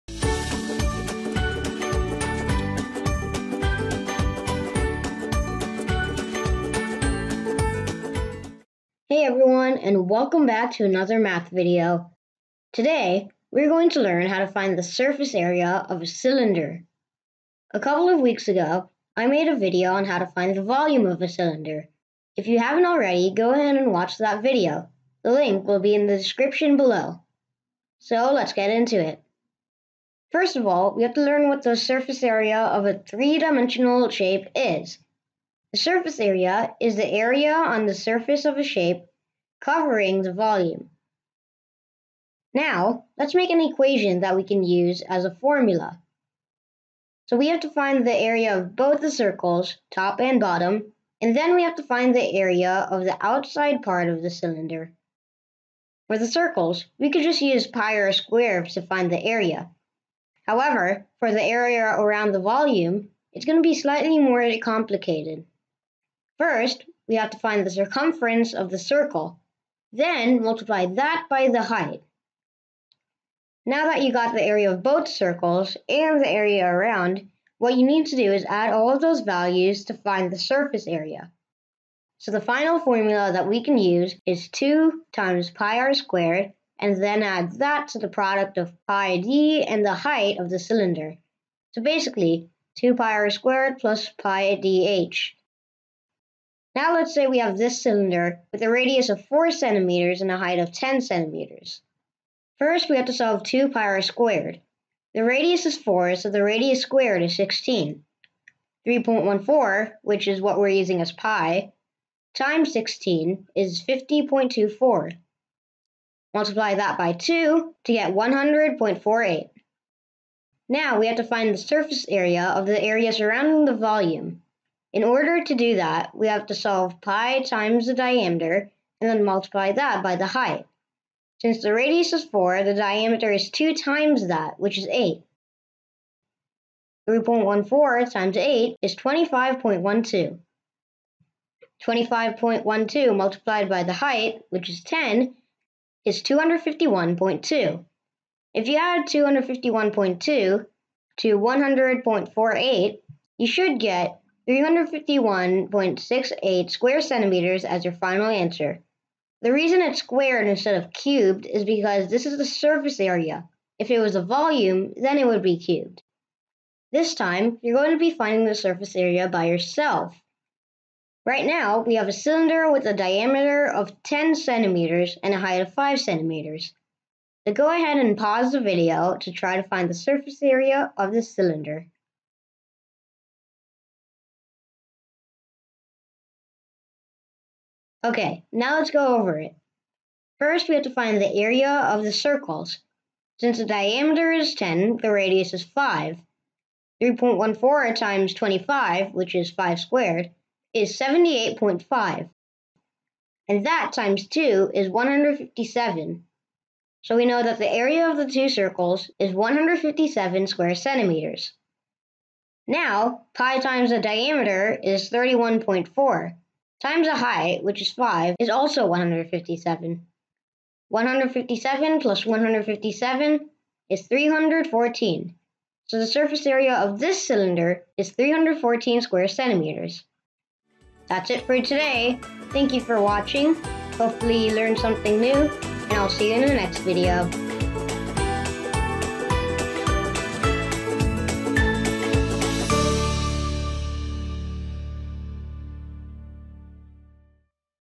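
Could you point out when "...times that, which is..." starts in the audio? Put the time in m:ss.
2:13.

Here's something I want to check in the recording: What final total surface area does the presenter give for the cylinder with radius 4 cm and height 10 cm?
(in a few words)
351.68 square centimeters.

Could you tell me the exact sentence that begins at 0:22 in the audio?
If you haven't already, go ahead and watch that video.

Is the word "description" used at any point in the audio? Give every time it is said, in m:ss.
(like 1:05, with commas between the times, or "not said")
0:26.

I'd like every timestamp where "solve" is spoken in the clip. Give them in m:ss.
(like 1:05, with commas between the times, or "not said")
1:43, 2:06.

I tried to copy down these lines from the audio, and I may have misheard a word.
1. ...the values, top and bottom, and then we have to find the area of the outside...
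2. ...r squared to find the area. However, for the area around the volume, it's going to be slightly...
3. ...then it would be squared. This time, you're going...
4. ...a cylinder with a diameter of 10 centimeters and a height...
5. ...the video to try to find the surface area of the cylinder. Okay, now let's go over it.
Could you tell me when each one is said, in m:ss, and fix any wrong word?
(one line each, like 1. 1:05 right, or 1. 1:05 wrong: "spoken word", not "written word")
1. 0:48 wrong: "circles", not "values"
2. 0:57 right
3. 2:44 wrong: "cubed", not "squared"
4. 2:52 right
5. 2:58 right.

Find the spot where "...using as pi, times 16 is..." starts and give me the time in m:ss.
1:50.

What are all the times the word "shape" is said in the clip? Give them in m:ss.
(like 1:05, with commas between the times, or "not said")
0:34, 0:38.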